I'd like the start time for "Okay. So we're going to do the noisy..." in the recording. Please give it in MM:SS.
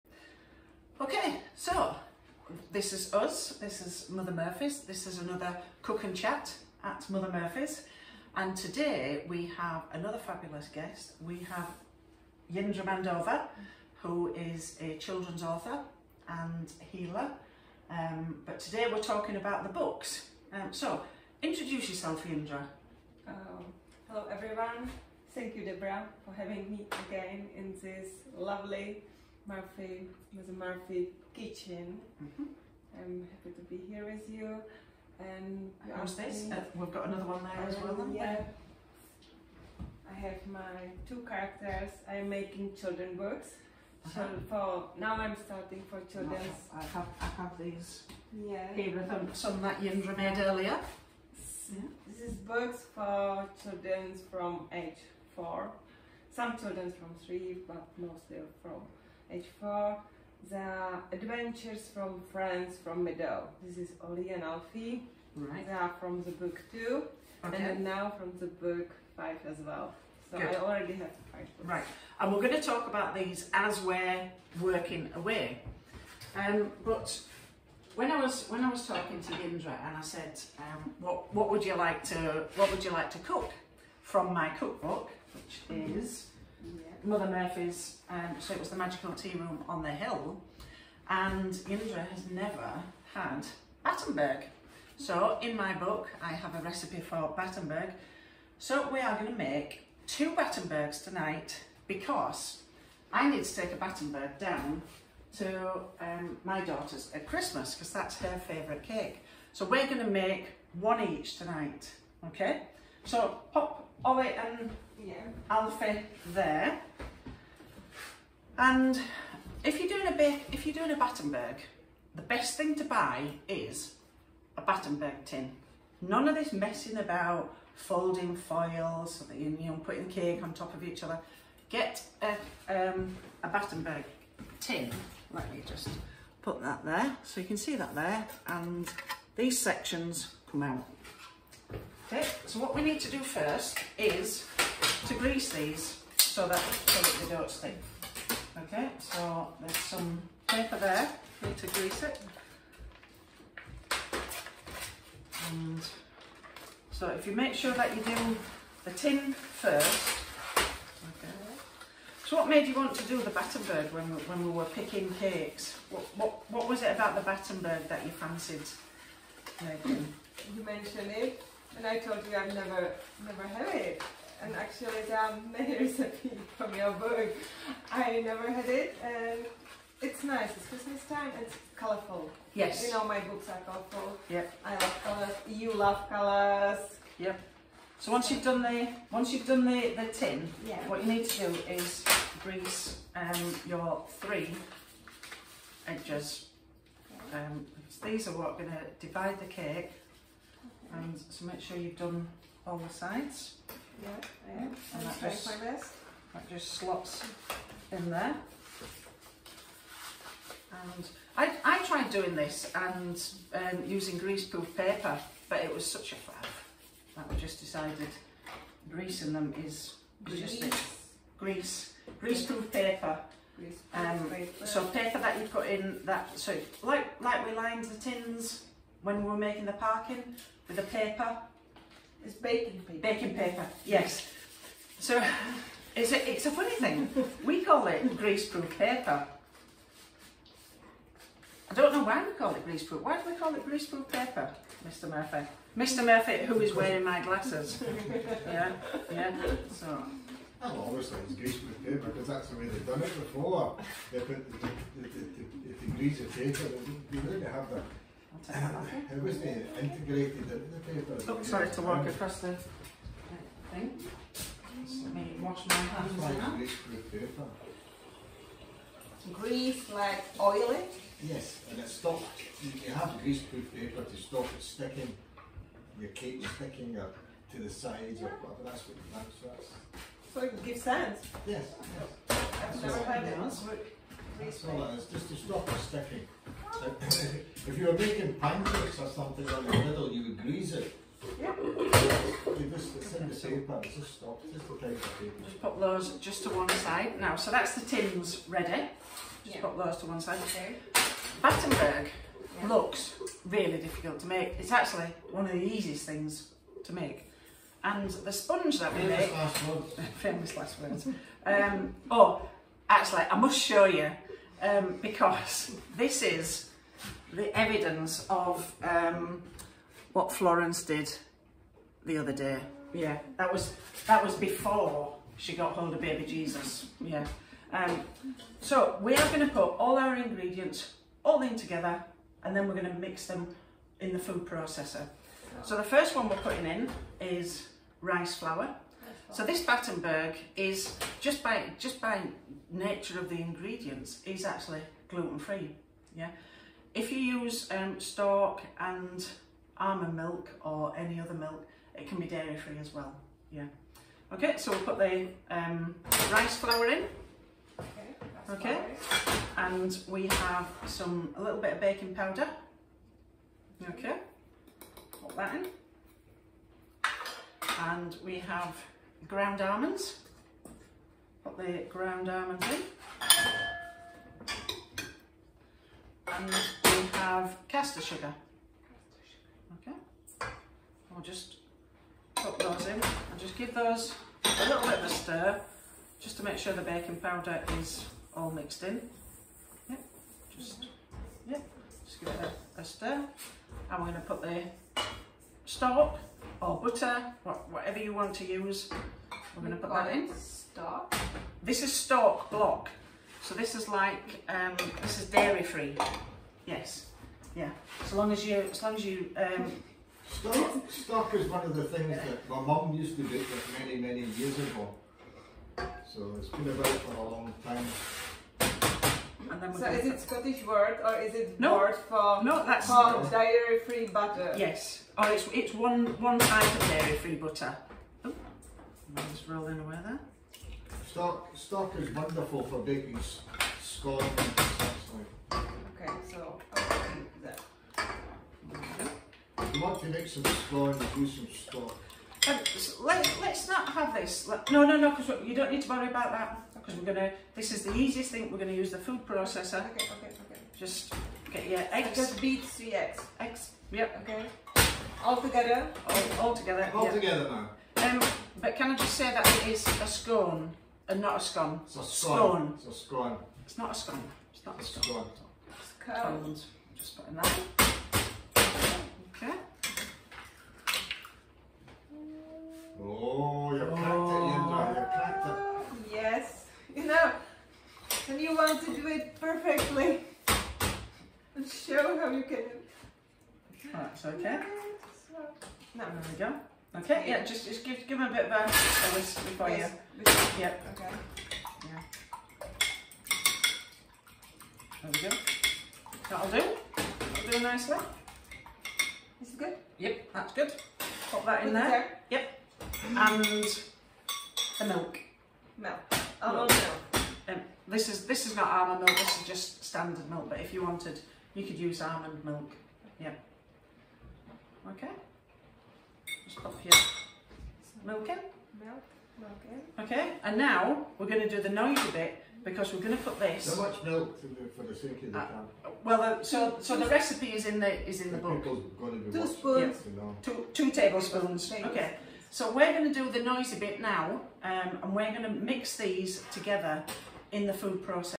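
08:51.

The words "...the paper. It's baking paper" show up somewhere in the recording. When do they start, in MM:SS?
03:50.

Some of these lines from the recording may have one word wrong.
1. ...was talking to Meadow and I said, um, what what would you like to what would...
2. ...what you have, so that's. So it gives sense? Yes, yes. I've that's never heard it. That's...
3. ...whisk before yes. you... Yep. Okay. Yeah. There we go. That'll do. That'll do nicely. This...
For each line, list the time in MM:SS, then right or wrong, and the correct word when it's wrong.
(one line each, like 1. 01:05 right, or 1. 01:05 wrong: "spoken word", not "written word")
1. 01:18 wrong: "Jindra", not "Meadow"
2. 04:38 right
3. 08:09 right.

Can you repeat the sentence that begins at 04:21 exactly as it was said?
Oh, sorry, to walk across the thing.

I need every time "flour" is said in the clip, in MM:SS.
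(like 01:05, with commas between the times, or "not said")
05:38, 05:56.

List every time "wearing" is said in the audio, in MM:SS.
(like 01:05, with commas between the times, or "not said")
04:06.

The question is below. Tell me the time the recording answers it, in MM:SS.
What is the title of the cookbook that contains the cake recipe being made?
01:28.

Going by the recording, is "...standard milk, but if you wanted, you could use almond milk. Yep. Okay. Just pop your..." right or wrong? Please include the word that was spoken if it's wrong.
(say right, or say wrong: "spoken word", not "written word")
right.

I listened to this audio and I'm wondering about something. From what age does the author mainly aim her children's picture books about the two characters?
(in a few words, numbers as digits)
4.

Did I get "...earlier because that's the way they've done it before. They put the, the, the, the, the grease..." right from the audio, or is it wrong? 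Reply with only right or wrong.
wrong.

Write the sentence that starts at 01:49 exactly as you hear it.
So we're gonna make one each tonight, okay?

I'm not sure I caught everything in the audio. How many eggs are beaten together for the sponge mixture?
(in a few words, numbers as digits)
3.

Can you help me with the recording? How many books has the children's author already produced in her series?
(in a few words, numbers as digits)
5.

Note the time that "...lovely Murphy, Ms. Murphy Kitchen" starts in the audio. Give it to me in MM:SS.
00:28.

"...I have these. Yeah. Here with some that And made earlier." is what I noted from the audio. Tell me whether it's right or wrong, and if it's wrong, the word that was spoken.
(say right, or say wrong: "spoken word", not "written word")
wrong: "Jindra", not "And".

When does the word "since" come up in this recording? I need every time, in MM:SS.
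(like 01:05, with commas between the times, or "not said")
not said.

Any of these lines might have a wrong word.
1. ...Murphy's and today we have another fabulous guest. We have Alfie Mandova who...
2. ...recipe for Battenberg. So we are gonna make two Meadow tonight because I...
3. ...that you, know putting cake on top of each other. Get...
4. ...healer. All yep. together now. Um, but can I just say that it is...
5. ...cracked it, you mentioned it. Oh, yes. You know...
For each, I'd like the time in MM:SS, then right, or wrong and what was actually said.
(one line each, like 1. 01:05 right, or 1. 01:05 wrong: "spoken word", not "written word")
1. 00:07 wrong: "Jindra", not "Alfie"
2. 01:36 wrong: "Battenbergs", not "Meadow"
3. 02:09 right
4. 07:36 wrong: "together", not "healer"
5. 07:53 wrong: "cracked", not "mentioned".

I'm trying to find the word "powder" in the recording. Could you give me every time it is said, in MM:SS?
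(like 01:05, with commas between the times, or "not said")
06:02, 06:27.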